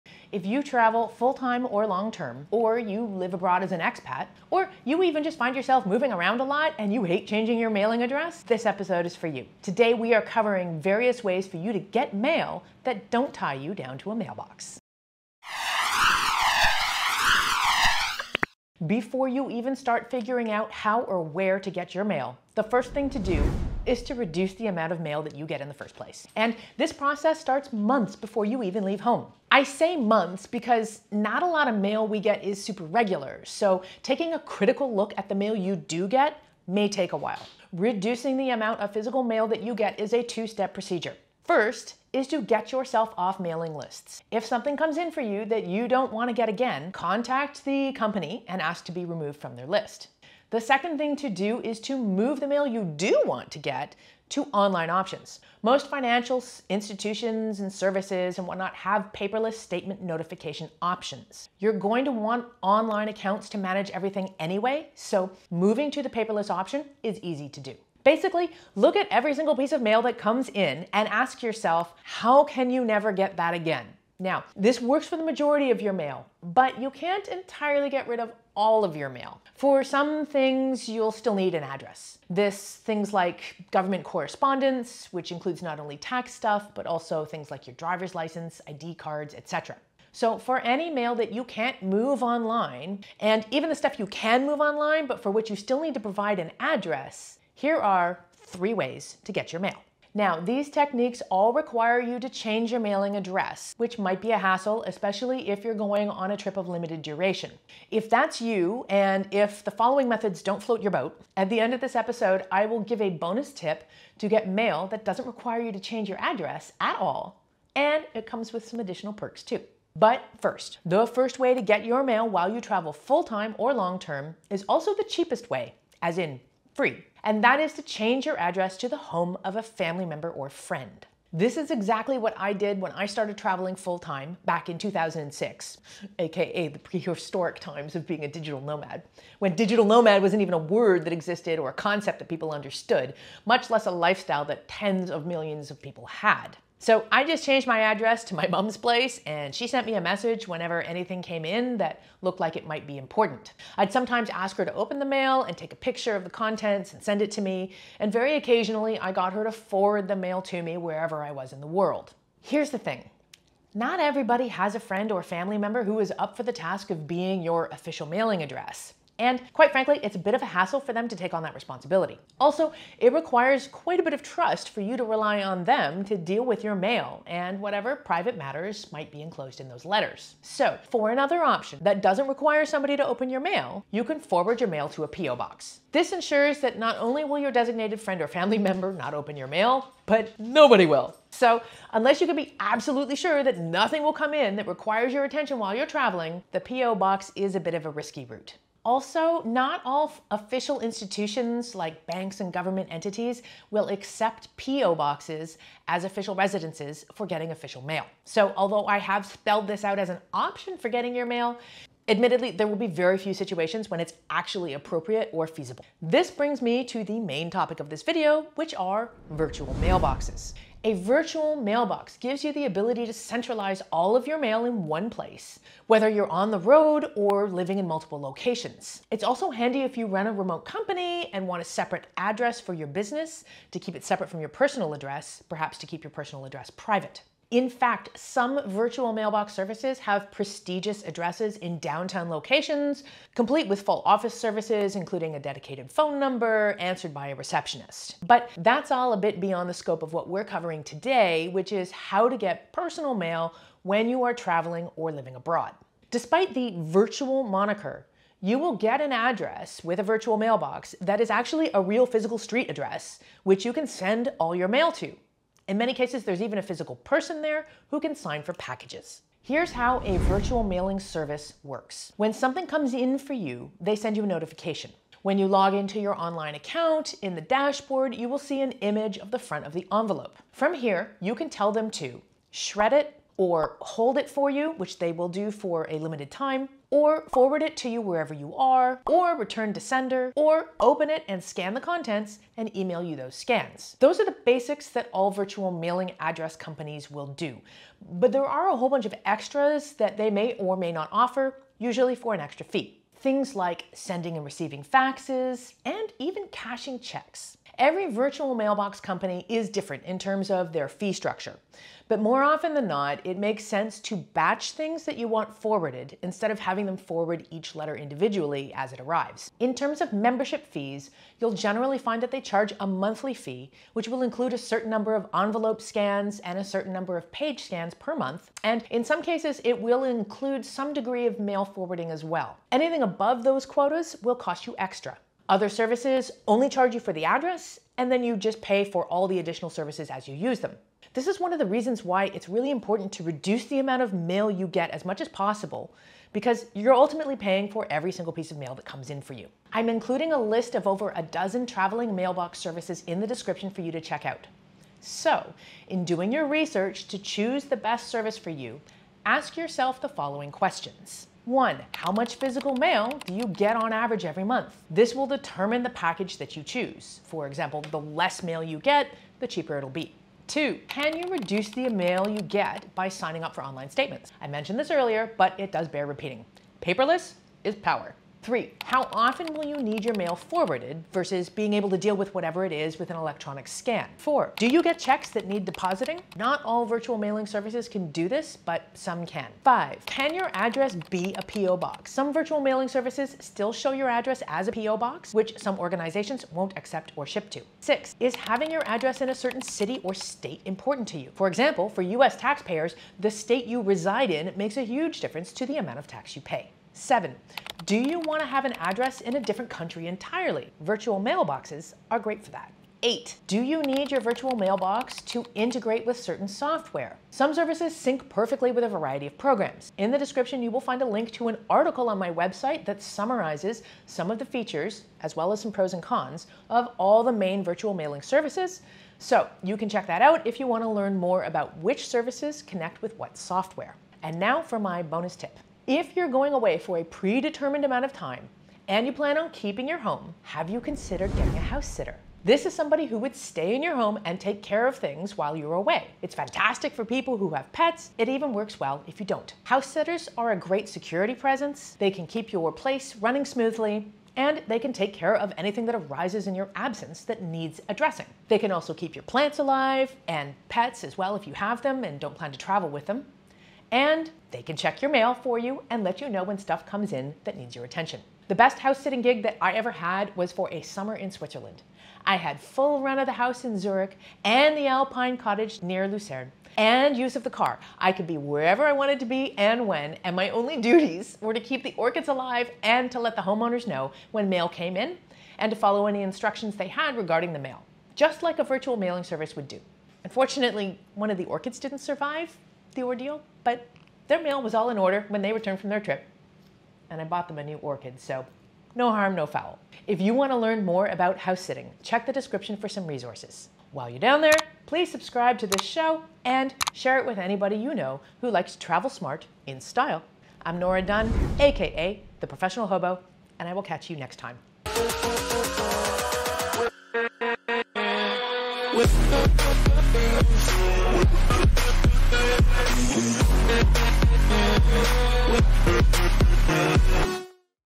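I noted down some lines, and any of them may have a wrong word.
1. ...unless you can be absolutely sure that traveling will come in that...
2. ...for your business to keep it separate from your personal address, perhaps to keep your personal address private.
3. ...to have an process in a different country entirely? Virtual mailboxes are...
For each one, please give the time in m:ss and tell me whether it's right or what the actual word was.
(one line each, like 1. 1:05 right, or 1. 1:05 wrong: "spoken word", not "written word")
1. 3:11 wrong: "nothing", not "traveling"
2. 3:52 right
3. 6:48 wrong: "address", not "process".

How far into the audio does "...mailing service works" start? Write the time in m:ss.
4:30.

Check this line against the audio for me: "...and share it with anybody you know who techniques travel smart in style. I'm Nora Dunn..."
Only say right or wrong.
wrong.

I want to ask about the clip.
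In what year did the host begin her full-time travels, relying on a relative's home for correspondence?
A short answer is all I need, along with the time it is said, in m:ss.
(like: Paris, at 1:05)
2006, at 2:14.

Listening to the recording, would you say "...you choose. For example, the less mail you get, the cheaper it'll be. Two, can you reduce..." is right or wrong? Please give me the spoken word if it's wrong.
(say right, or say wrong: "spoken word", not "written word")
right.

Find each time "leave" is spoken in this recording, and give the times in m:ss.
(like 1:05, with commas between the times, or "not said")
0:28.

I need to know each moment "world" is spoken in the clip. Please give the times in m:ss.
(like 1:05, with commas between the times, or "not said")
2:41.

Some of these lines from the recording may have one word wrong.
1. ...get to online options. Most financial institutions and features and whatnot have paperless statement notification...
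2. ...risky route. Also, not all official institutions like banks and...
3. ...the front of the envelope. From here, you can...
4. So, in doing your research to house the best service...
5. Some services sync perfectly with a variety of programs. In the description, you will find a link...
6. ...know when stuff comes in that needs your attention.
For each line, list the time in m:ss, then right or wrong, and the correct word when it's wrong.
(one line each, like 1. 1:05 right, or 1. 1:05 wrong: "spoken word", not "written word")
1. 0:53 wrong: "services", not "features"
2. 3:17 right
3. 4:39 right
4. 5:55 wrong: "choose", not "house"
5. 6:57 right
6. 7:46 right.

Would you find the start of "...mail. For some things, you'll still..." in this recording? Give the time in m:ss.
1:19.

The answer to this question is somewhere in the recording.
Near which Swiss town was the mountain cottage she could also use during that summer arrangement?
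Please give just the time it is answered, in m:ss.
7:56.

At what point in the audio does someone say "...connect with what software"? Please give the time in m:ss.
7:12.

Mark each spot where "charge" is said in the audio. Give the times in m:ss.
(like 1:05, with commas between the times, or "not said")
5:22, 5:36.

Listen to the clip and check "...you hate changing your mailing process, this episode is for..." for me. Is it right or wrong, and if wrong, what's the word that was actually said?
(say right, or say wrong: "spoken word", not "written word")
wrong: "address", not "process".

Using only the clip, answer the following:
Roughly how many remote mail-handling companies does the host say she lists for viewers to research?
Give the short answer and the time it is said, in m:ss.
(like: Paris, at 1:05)
Over a dozen, at 5:50.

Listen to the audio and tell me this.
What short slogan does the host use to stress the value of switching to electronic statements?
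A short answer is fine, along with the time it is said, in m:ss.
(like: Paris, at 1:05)
Paperless is power, at 6:16.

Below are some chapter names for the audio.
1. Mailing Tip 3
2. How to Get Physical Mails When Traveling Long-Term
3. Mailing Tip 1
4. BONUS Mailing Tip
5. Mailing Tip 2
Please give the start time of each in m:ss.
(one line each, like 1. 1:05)
1. 3:40
2. 0:19
3. 2:00
4. 7:20
5. 3:03.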